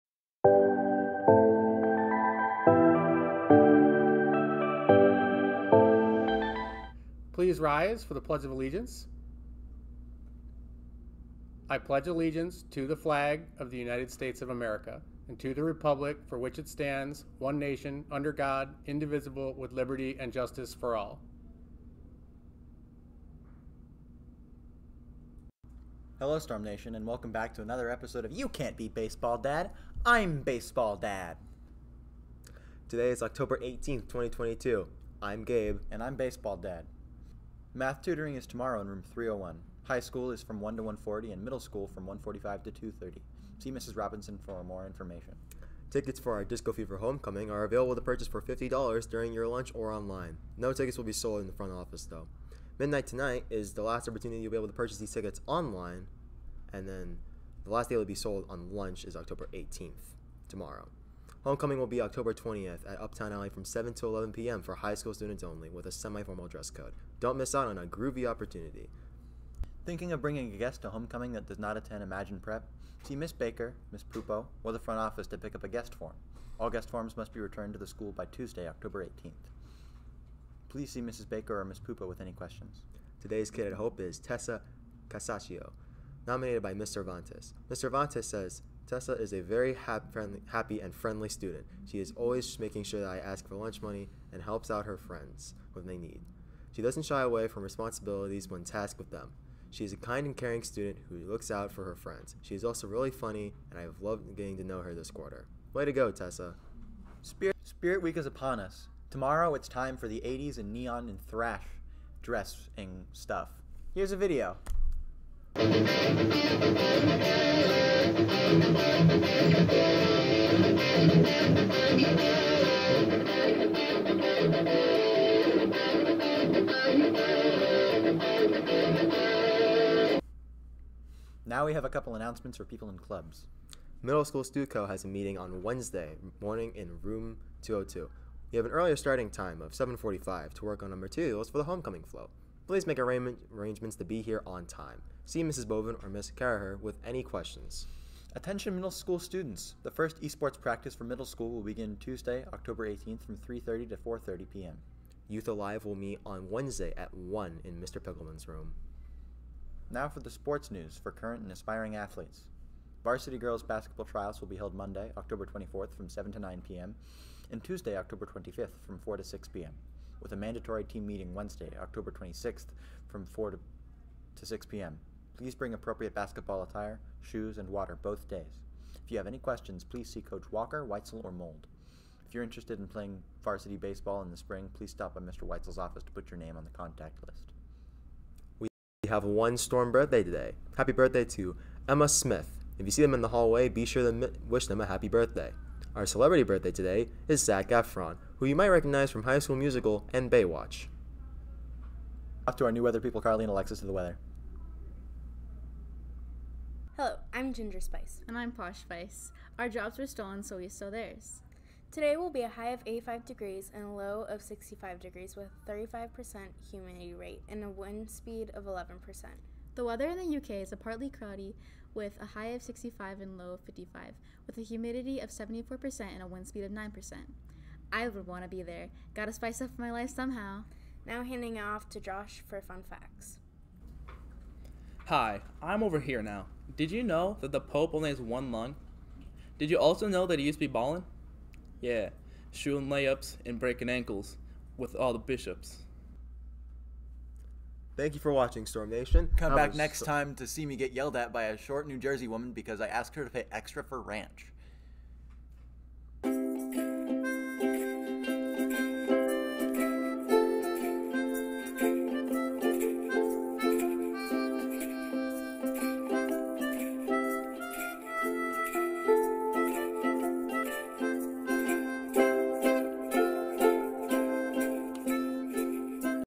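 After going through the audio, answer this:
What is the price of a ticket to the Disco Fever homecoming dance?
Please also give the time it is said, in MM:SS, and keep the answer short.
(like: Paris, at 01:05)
$50, at 00:48.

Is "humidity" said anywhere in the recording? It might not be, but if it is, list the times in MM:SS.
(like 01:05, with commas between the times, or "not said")
03:36, 03:44.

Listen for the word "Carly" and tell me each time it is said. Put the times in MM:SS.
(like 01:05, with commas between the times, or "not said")
03:23.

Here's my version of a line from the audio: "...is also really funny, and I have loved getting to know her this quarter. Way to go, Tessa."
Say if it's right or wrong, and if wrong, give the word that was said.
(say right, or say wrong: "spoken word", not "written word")
right.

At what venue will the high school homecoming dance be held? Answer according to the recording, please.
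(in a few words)
Uptown Alley.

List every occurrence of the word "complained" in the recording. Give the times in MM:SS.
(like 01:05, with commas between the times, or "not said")
not said.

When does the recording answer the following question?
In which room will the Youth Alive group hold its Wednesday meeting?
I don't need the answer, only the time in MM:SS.
02:37.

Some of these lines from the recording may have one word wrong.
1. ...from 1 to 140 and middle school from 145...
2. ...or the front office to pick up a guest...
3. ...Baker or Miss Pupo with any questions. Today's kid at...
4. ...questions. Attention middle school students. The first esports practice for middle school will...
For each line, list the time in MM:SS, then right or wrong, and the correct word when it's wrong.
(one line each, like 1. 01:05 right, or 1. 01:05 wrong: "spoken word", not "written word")
1. 00:40 right
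2. 01:14 right
3. 01:21 right
4. 02:27 right.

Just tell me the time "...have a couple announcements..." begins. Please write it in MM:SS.
02:11.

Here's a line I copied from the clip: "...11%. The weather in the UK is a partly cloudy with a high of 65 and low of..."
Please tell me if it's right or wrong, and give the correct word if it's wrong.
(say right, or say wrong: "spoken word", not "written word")
right.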